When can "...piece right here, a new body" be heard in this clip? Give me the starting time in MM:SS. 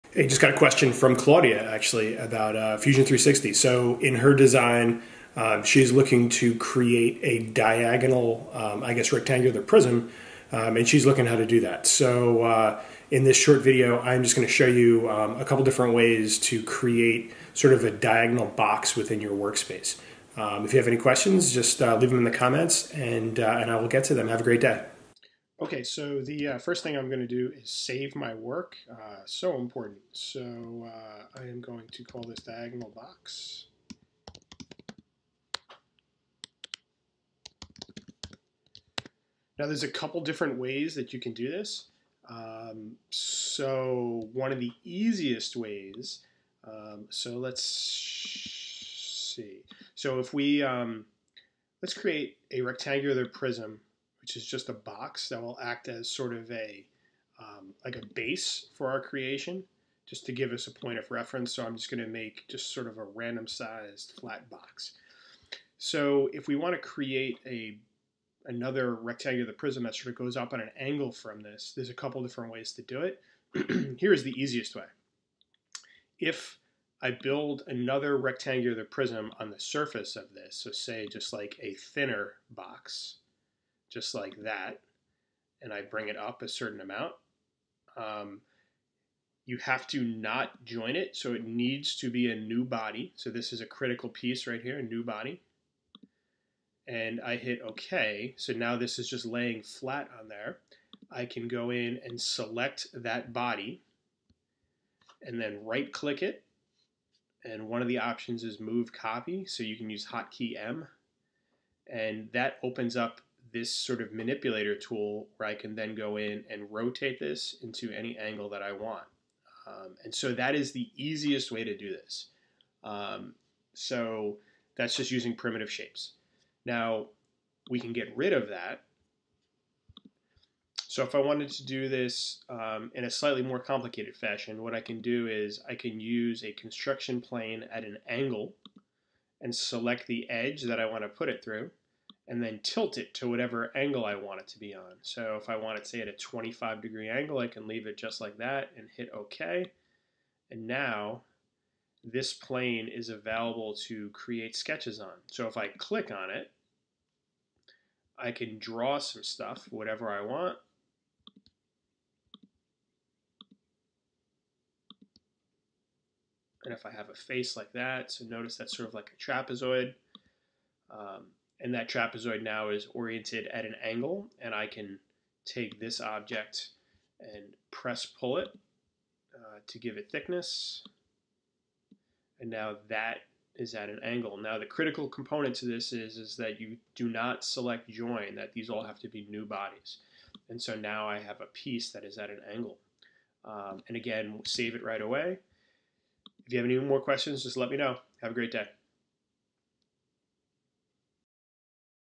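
01:34.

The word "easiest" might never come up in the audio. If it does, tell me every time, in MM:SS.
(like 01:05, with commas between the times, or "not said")
00:44, 01:14, 02:00.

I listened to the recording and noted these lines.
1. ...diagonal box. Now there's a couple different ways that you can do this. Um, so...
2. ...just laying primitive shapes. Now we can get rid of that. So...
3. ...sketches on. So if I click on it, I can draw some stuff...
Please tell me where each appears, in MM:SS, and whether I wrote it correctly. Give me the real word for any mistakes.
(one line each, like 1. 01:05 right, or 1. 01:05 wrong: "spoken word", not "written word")
1. 00:32 right
2. 02:04 wrong: "using", not "laying"
3. 02:34 right.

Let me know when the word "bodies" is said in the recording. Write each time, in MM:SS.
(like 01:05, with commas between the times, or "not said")
03:09.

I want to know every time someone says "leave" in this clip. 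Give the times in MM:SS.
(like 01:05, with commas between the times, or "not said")
00:21, 02:27.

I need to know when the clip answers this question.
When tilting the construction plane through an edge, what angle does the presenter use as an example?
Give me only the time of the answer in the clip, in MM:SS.
02:26.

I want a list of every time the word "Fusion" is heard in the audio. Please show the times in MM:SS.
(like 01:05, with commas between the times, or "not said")
00:02.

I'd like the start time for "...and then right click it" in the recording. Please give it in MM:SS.
01:45.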